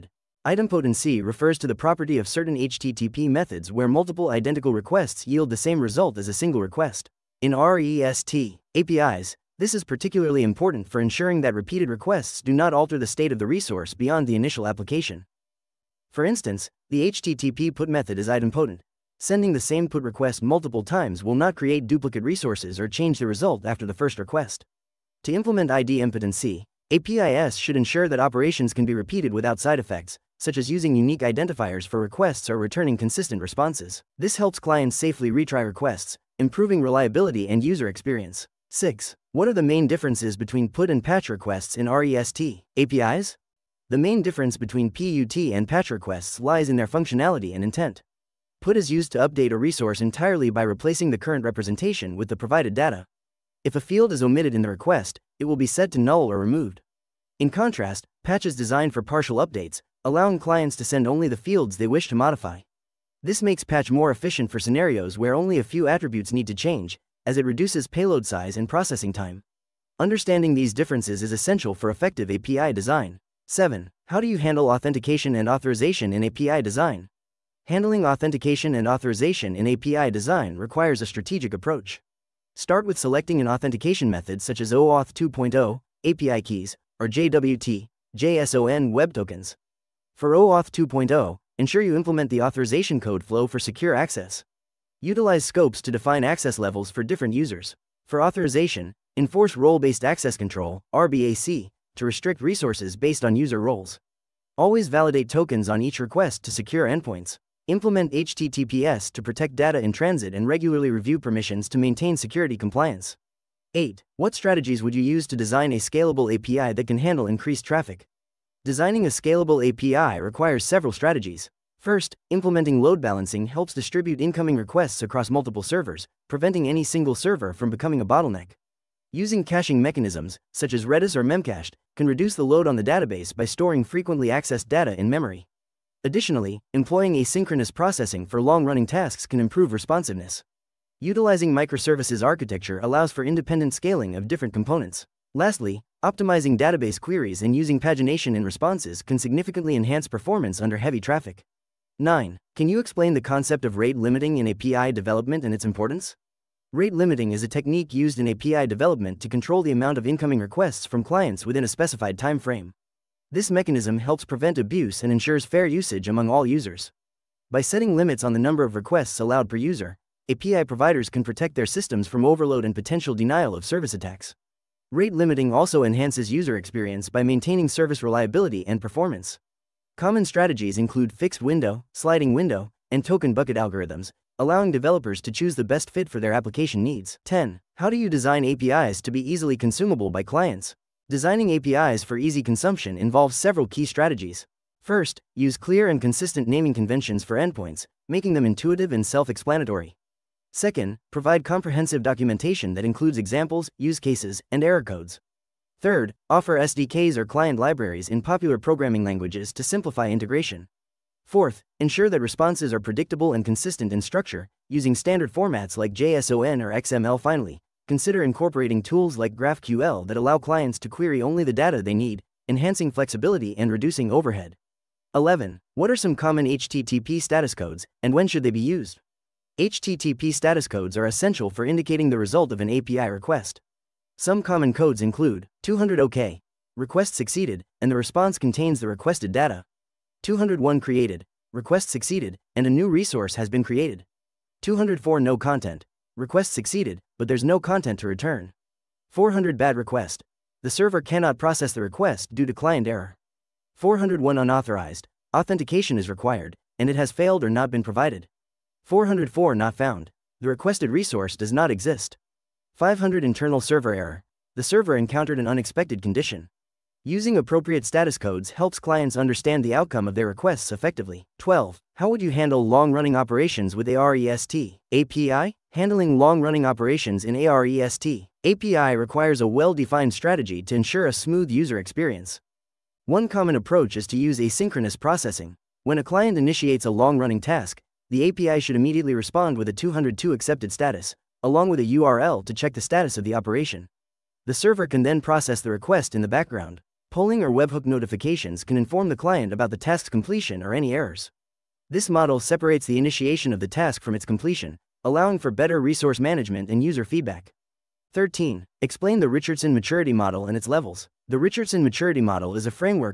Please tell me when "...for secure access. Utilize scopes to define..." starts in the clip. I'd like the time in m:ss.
1:33.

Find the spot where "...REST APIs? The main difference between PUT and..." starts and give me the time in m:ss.
0:41.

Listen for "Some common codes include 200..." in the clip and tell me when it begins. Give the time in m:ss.
3:54.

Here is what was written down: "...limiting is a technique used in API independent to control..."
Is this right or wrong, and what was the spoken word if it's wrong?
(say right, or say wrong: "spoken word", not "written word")
wrong: "development", not "independent".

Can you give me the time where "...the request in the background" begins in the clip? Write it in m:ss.
4:55.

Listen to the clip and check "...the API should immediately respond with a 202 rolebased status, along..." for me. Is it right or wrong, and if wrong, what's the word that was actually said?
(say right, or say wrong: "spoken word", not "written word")
wrong: "accepted", not "rolebased".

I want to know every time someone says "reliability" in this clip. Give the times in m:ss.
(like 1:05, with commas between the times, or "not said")
0:36, 2:58.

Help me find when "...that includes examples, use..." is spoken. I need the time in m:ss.
3:22.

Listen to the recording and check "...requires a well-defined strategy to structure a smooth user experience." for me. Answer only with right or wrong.
wrong.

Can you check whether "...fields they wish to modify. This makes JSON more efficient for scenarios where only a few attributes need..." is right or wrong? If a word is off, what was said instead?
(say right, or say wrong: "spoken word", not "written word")
wrong: "Patch", not "JSON".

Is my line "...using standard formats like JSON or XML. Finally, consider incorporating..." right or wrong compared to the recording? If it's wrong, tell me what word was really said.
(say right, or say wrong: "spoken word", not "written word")
right.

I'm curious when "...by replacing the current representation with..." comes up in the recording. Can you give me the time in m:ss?
0:50.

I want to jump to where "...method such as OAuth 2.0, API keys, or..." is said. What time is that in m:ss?
1:24.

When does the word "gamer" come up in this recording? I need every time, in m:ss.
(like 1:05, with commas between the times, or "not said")
not said.